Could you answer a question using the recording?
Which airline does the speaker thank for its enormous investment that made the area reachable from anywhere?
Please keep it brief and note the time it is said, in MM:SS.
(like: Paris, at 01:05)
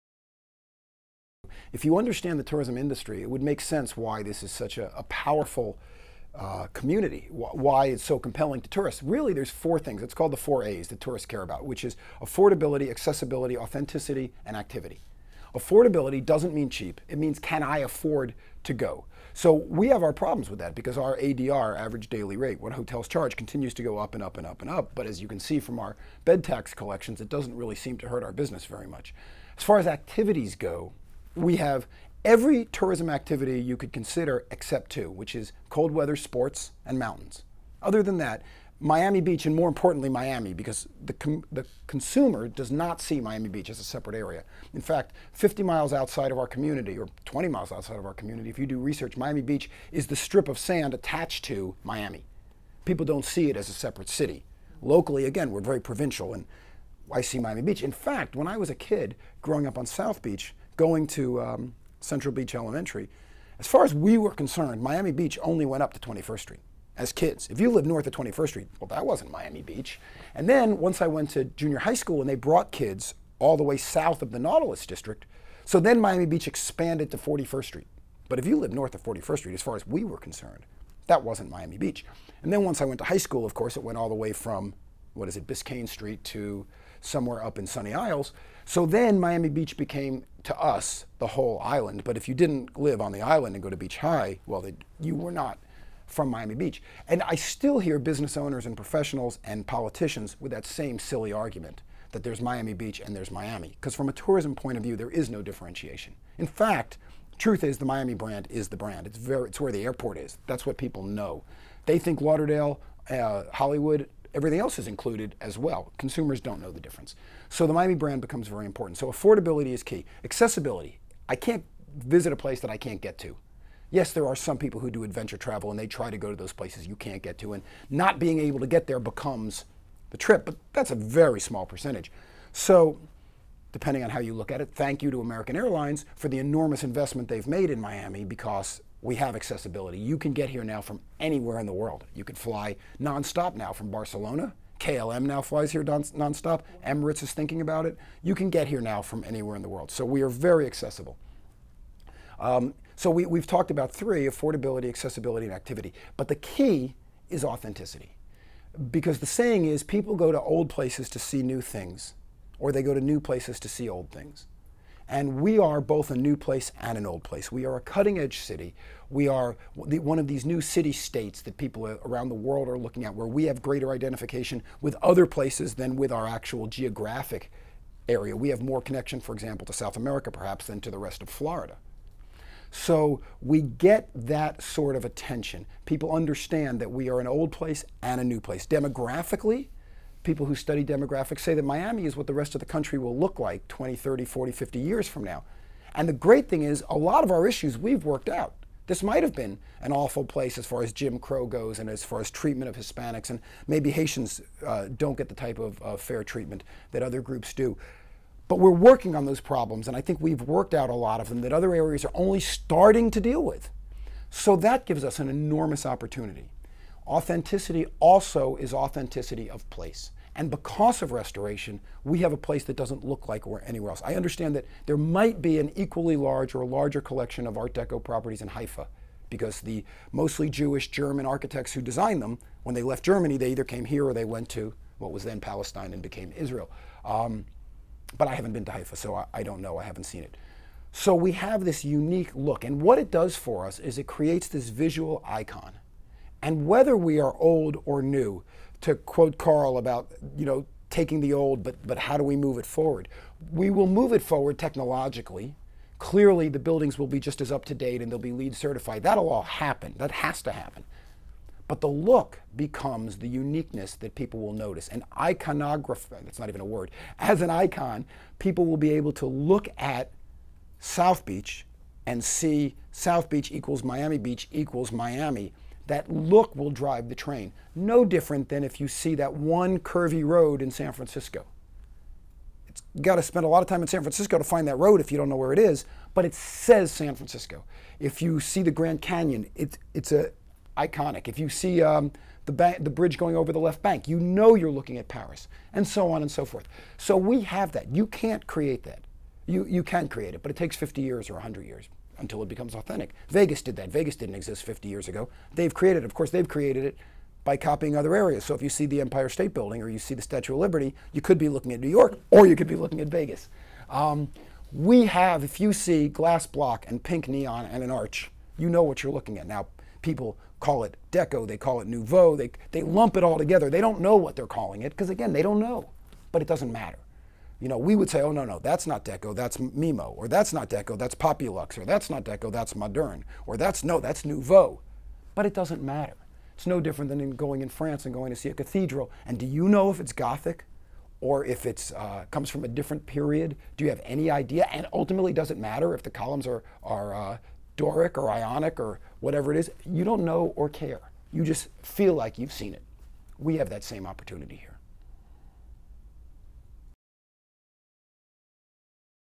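American Airlines, at 02:15.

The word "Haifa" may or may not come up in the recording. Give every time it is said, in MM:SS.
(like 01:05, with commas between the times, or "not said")
03:48, 03:58.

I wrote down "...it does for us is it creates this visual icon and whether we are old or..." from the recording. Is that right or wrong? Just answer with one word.
right.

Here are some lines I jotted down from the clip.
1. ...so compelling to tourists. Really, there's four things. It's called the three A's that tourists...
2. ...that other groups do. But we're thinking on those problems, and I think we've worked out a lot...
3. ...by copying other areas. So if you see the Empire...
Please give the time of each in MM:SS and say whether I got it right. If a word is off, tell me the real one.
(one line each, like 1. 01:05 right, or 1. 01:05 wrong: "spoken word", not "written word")
1. 00:08 wrong: "four", not "three"
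2. 03:26 wrong: "working", not "thinking"
3. 05:07 right.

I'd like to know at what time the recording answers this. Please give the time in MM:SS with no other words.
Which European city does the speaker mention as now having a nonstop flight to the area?
02:23.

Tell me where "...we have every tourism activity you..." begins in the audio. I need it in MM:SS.
00:31.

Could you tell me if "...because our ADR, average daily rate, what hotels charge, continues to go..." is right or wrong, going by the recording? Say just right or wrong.
right.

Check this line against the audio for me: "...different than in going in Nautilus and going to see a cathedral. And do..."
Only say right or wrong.
wrong.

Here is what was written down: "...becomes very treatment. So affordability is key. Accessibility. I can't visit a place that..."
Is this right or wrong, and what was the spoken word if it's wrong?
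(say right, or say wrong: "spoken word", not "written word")
wrong: "important", not "treatment".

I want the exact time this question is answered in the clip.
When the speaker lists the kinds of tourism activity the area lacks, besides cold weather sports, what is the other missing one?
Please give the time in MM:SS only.
00:36.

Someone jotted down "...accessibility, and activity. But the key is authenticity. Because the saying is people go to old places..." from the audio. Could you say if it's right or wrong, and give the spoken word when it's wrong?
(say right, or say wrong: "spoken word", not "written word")
right.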